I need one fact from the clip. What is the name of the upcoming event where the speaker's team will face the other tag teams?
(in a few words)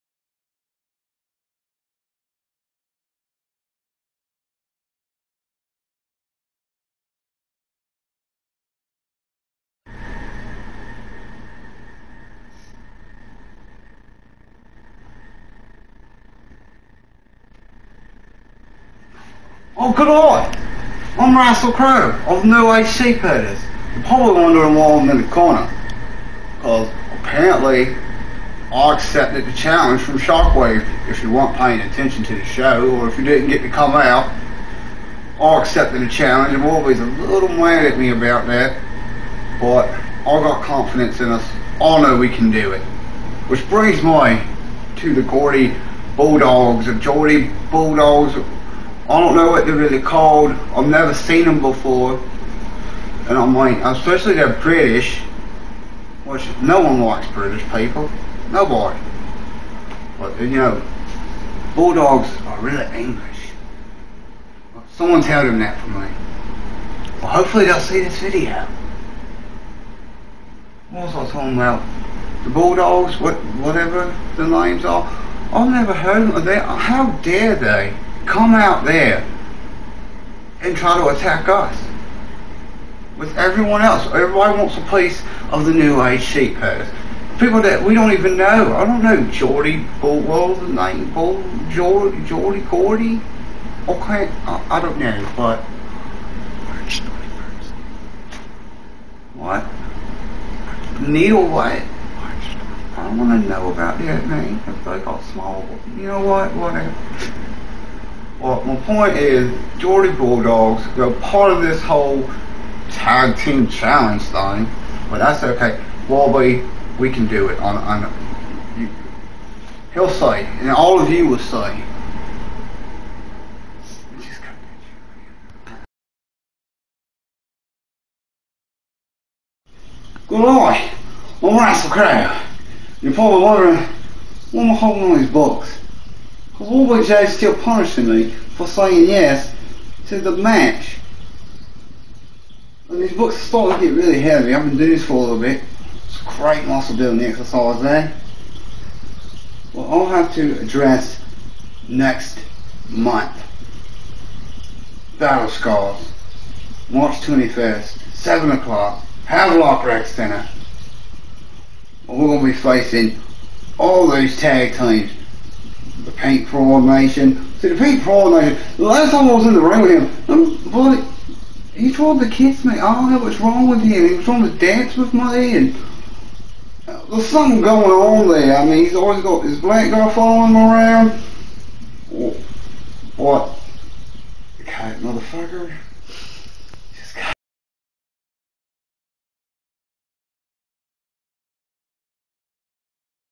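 Battle Scars.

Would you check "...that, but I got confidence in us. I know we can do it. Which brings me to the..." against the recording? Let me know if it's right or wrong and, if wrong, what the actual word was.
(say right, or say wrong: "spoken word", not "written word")
right.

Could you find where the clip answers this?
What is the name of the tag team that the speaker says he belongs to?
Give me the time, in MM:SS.
00:22.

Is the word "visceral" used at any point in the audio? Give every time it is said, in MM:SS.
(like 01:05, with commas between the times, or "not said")
not said.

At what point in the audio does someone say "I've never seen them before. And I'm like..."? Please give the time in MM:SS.
00:50.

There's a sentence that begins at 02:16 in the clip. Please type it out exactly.
Warwick jays still punishing me for saying yes to the match.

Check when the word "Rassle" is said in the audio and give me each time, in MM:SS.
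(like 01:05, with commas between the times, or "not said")
00:21, 02:11.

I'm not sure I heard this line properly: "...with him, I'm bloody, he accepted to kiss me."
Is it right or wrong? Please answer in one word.
wrong.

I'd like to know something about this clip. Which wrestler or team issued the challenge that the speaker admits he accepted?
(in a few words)
Shockwave.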